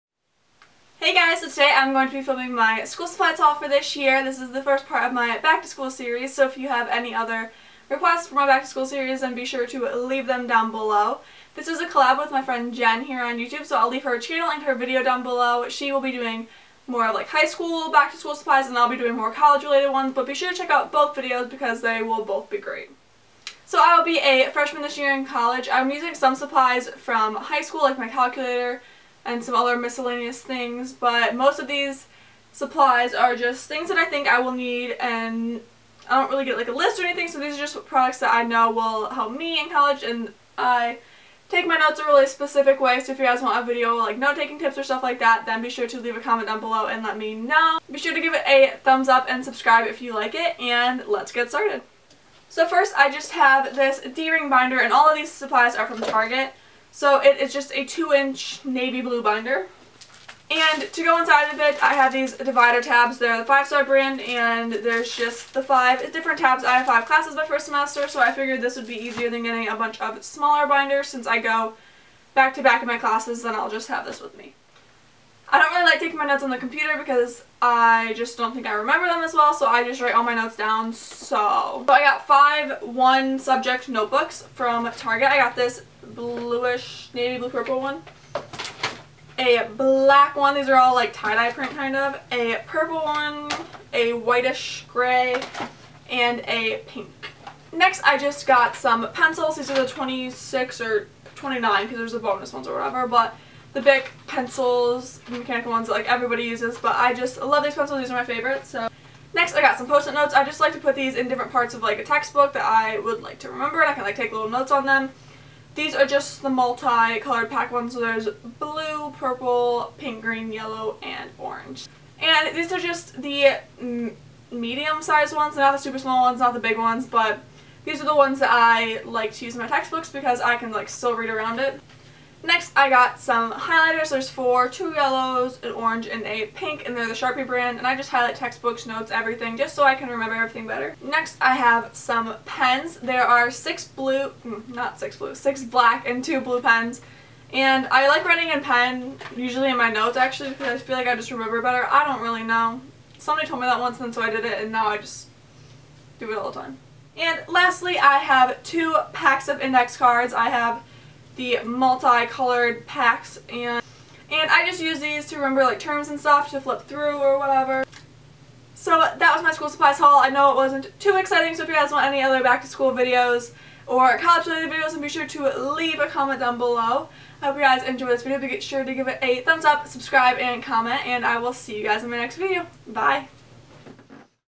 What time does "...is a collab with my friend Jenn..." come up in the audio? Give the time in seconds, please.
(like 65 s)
11 s.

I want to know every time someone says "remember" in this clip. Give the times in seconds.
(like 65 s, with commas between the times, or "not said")
78 s, 113 s, 140 s, 151 s, 165 s.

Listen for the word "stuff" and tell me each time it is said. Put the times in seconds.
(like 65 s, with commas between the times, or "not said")
44 s, 166 s.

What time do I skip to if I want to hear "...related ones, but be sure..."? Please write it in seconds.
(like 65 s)
19 s.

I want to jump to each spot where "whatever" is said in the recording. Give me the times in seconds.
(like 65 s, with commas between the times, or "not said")
102 s, 167 s.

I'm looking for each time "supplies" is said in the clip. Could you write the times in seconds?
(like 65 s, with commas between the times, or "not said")
3 s, 18 s, 26 s, 32 s, 55 s, 169 s.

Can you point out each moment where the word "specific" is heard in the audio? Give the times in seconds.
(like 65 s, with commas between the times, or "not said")
42 s.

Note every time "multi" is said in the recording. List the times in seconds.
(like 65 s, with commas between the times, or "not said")
116 s, 161 s.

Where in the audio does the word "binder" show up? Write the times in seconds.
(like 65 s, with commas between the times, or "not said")
54 s, 59 s, 70 s.